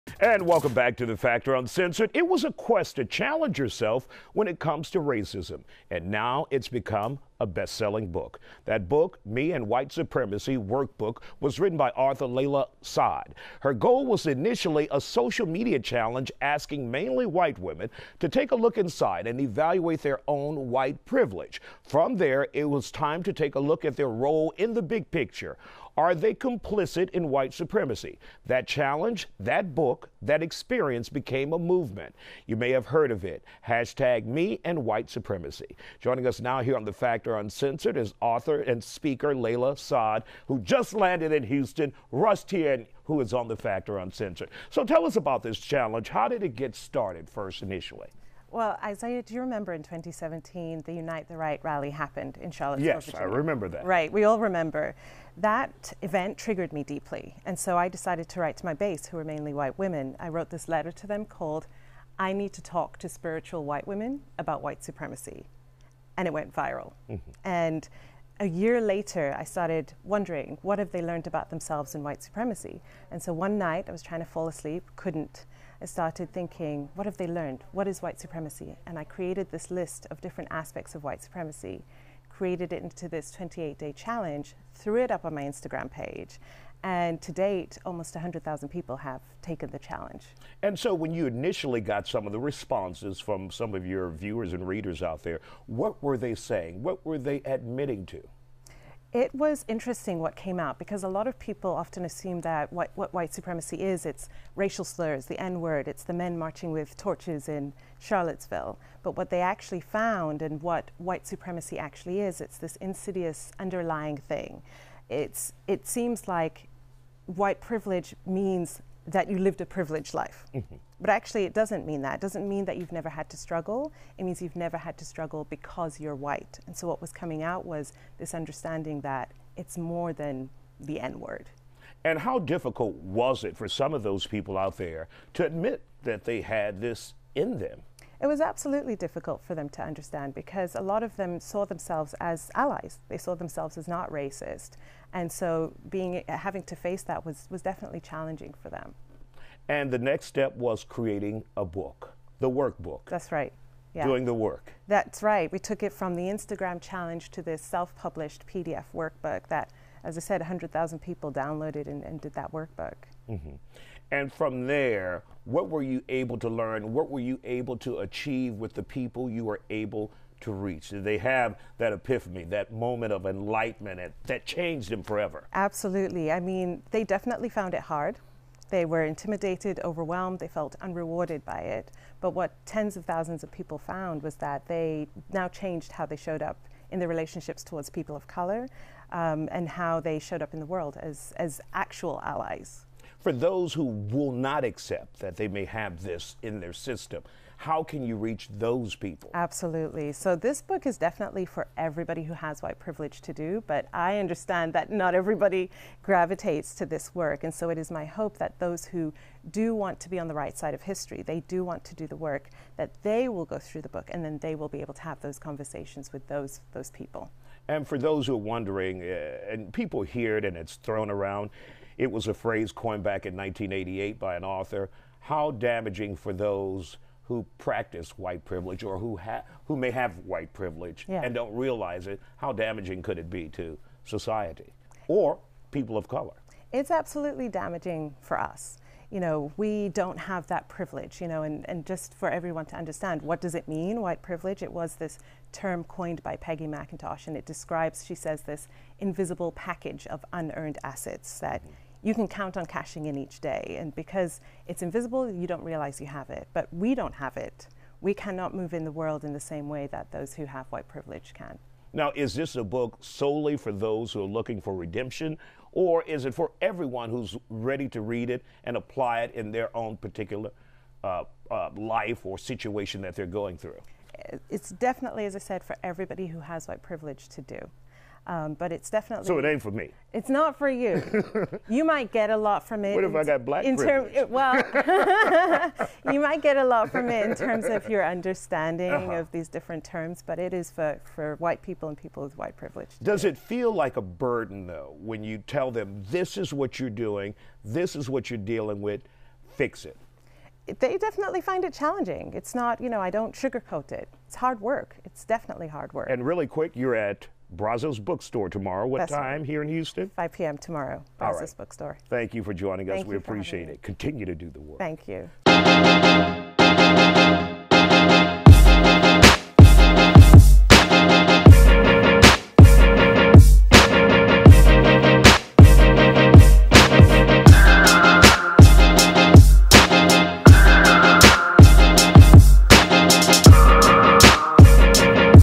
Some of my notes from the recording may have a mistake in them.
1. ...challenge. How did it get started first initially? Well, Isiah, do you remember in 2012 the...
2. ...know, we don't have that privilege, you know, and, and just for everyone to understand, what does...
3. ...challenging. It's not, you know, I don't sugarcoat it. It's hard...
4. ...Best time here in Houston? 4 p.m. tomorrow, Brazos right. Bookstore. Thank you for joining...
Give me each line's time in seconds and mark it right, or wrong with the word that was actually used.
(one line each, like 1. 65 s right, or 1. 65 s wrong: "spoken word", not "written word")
1. 45 s wrong: "2017", not "2012"
2. 239 s right
3. 301 s right
4. 308 s wrong: "5", not "4".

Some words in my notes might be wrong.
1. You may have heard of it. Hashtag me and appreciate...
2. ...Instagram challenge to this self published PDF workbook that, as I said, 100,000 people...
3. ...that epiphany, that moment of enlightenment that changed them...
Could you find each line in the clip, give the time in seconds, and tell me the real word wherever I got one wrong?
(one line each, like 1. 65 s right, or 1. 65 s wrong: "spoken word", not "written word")
1. 32 s wrong: "white", not "appreciate"
2. 156 s right
3. 171 s right.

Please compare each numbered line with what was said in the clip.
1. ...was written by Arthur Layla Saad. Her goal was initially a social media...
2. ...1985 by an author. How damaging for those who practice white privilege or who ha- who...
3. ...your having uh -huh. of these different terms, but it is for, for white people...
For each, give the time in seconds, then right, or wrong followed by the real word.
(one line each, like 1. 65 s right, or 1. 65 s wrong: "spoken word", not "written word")
1. 11 s right
2. 223 s wrong: "1988", not "1985"
3. 287 s wrong: "understanding", not "having".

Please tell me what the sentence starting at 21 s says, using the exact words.
From there, it was time to take a look at their role in the big picture.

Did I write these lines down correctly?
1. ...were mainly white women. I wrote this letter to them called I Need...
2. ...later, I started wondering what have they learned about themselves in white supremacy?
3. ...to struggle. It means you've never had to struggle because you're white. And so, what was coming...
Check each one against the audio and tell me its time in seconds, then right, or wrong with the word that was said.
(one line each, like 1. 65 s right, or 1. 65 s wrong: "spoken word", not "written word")
1. 59 s right
2. 68 s right
3. 123 s right.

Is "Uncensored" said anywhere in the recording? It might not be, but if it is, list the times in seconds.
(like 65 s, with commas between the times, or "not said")
1 s, 37 s, 43 s.